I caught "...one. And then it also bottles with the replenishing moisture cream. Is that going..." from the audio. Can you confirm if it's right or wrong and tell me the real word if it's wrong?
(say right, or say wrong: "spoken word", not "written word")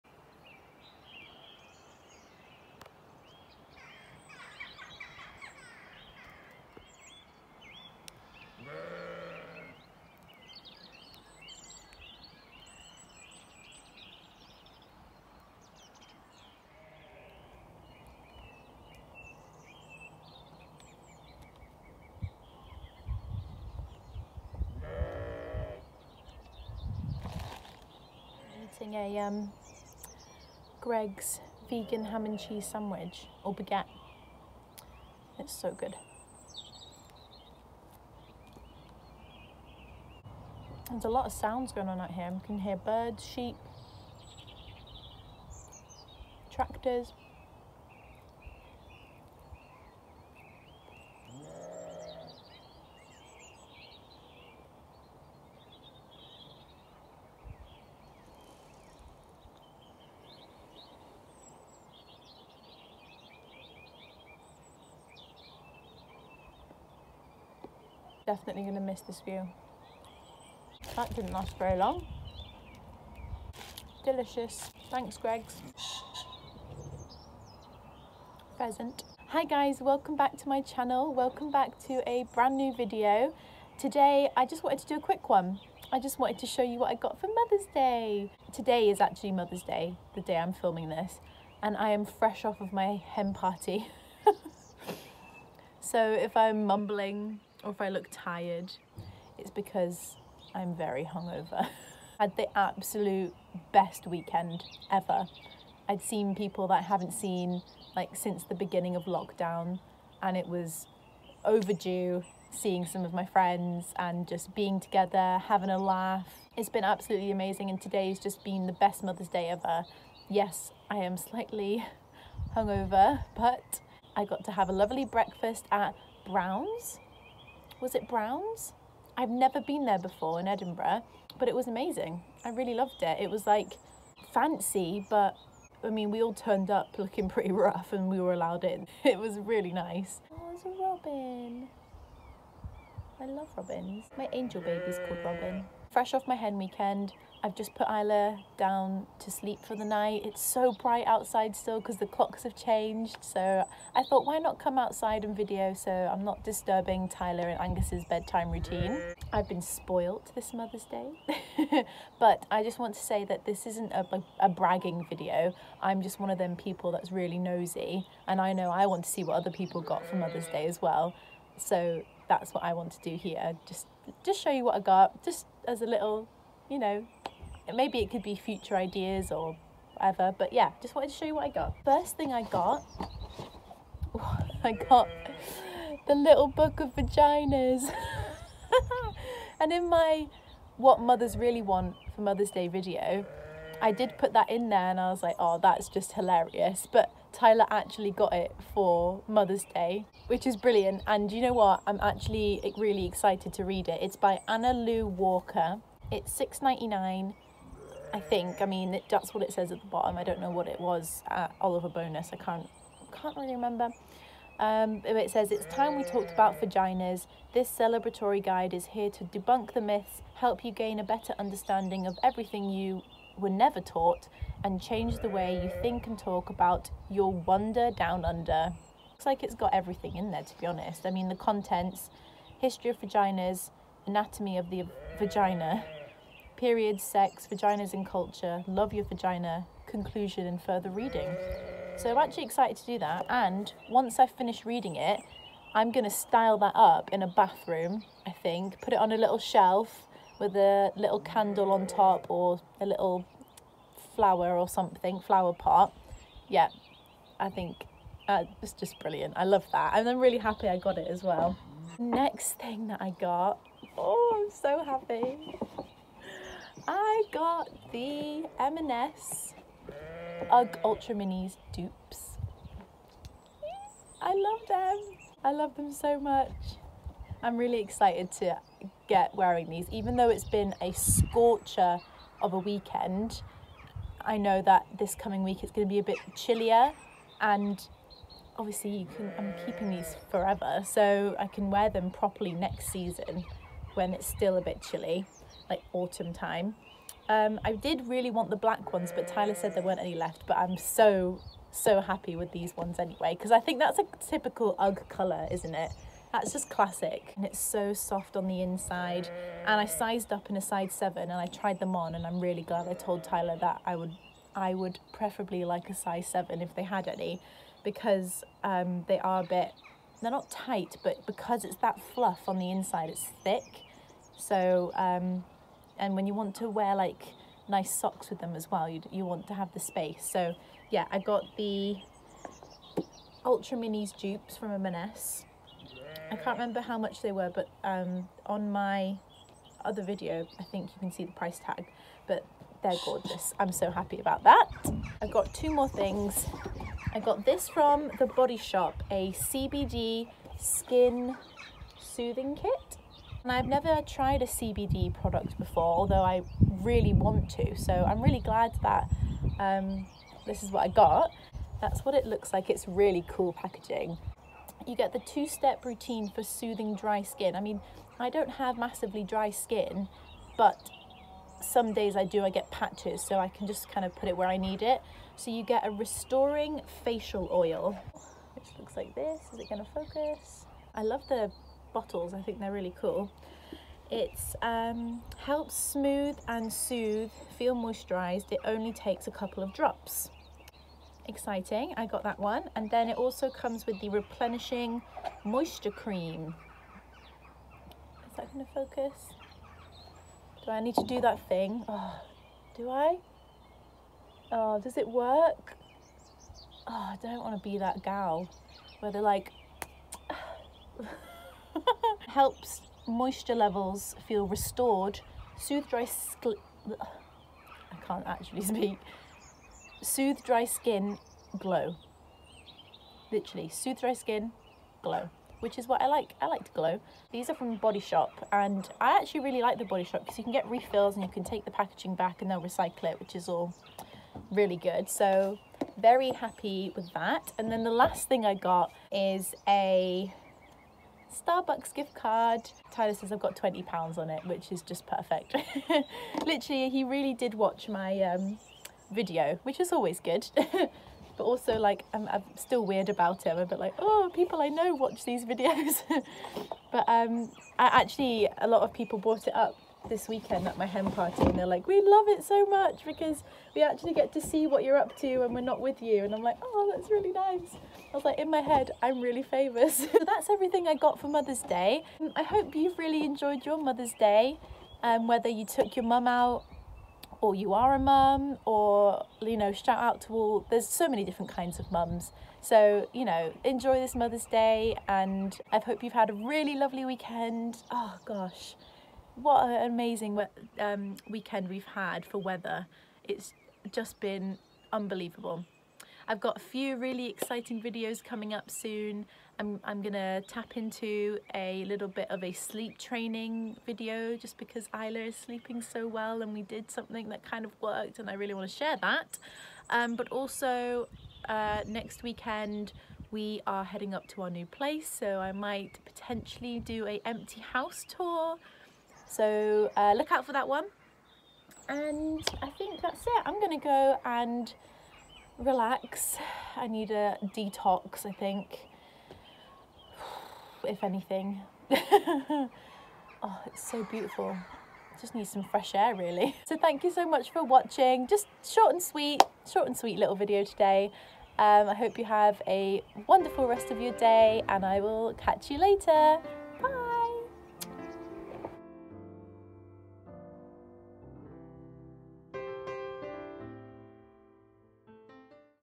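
wrong: "comes", not "bottles".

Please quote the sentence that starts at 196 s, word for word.
But Tyler actually got it for Mother's Day, which is brilliant.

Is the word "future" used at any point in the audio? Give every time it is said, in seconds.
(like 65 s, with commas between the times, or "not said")
178 s.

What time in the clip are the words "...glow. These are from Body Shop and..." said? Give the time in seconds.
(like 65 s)
426 s.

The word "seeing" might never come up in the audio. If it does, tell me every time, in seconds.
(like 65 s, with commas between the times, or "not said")
112 s.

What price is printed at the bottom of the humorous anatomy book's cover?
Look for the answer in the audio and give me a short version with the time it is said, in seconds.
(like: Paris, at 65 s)
6.99, at 206 s.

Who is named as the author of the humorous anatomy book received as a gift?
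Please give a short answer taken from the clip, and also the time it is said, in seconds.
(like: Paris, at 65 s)
Anna Lou Walker, at 204 s.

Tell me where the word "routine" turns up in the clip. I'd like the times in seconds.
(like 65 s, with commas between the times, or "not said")
158 s, 365 s.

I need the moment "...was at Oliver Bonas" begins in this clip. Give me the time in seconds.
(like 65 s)
210 s.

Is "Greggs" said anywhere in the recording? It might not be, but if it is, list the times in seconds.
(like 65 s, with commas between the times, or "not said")
30 s, 75 s.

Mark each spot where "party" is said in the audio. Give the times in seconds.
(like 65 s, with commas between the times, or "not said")
93 s, 461 s.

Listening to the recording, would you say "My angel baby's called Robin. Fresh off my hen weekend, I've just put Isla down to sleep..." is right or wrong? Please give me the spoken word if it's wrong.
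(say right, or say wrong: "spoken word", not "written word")
right.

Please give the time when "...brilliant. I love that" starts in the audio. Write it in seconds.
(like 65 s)
258 s.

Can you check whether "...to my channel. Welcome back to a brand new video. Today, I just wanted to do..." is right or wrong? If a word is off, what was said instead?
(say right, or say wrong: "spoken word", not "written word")
right.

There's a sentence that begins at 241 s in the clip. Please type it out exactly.
So I'm actually excited to do that.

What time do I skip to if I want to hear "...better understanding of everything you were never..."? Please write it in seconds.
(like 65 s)
221 s.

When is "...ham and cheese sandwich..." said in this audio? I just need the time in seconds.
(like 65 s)
32 s.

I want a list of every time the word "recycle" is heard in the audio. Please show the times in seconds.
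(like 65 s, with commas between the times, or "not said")
432 s.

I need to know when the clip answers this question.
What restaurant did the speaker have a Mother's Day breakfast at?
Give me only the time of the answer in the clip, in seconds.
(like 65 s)
128 s.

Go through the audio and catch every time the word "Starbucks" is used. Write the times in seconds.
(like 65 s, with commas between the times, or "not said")
441 s.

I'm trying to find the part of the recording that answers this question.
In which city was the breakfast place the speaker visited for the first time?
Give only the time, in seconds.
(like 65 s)
130 s.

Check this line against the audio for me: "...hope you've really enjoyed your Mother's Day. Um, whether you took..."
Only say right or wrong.
right.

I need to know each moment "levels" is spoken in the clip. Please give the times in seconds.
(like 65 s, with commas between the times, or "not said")
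413 s.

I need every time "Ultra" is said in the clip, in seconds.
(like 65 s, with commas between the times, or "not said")
270 s, 333 s.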